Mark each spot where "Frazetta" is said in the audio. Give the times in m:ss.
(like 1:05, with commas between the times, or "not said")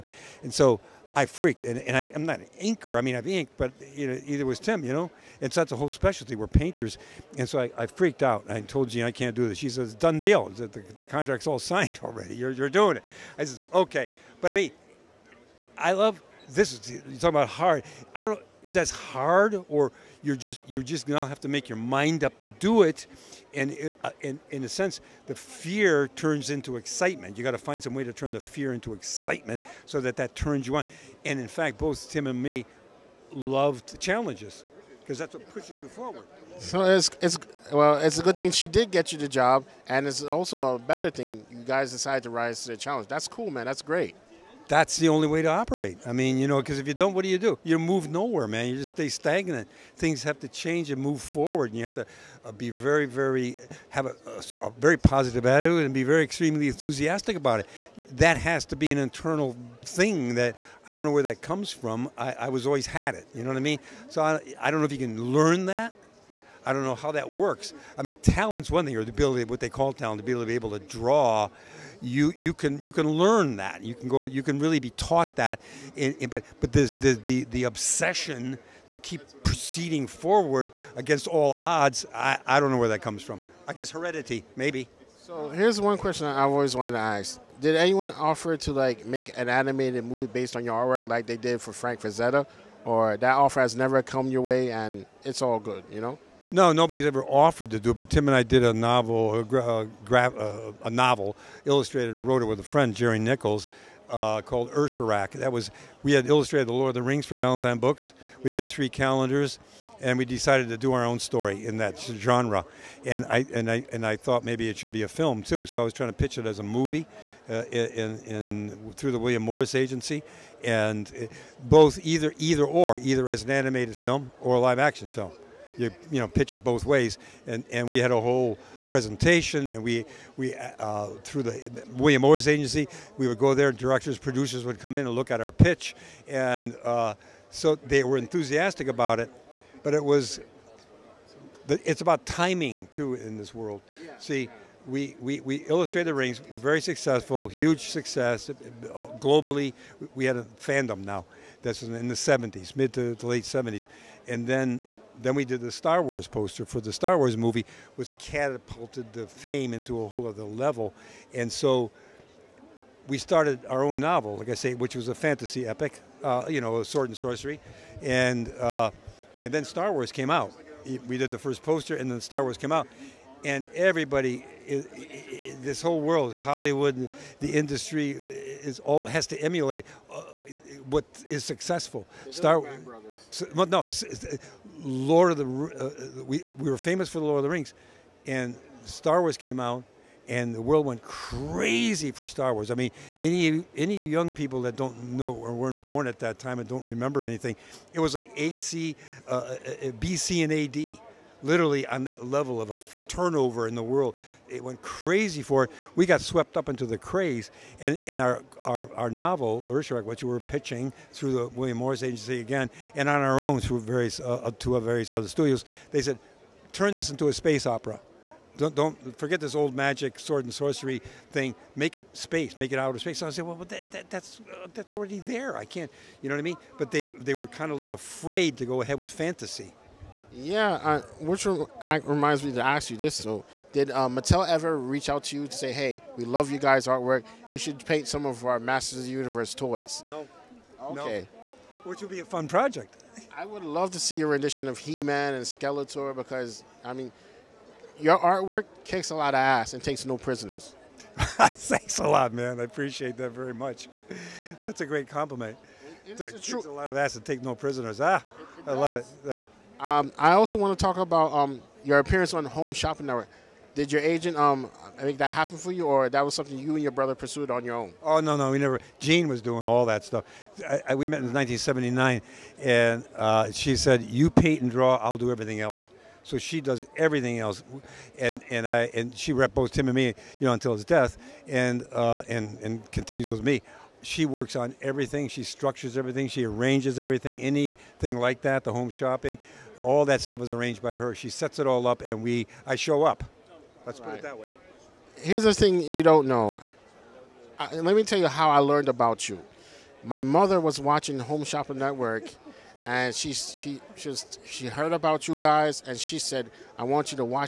1:32.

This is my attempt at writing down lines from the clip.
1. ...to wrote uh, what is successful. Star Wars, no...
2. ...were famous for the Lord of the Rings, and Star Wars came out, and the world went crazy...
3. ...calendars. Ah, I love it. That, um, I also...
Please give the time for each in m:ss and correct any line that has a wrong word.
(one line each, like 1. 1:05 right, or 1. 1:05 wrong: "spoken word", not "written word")
1. 2:59 wrong: "emulate", not "wrote"
2. 3:06 right
3. 4:17 wrong: "prisoners", not "calendars".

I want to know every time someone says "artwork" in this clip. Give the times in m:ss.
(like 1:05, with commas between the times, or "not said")
1:30, 3:56, 4:08.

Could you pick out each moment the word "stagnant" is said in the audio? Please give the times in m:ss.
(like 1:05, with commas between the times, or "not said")
0:49.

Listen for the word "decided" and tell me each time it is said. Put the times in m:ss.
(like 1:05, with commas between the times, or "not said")
0:41, 1:50.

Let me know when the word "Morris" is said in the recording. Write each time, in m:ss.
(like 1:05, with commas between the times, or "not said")
1:59, 2:12, 3:31.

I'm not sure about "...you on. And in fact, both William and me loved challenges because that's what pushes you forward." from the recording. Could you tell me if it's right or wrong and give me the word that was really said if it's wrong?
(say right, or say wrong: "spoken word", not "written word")
wrong: "Tim", not "William".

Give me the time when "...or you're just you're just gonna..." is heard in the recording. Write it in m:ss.
0:19.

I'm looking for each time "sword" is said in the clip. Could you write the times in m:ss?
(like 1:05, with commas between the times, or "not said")
2:46, 3:40.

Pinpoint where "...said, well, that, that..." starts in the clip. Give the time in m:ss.
3:43.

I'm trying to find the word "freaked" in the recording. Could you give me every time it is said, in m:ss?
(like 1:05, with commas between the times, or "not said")
0:01, 0:07.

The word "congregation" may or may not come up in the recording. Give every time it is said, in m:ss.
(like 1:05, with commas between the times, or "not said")
not said.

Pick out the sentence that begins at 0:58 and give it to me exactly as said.
That has to be an internal thing that I don't know where that comes from.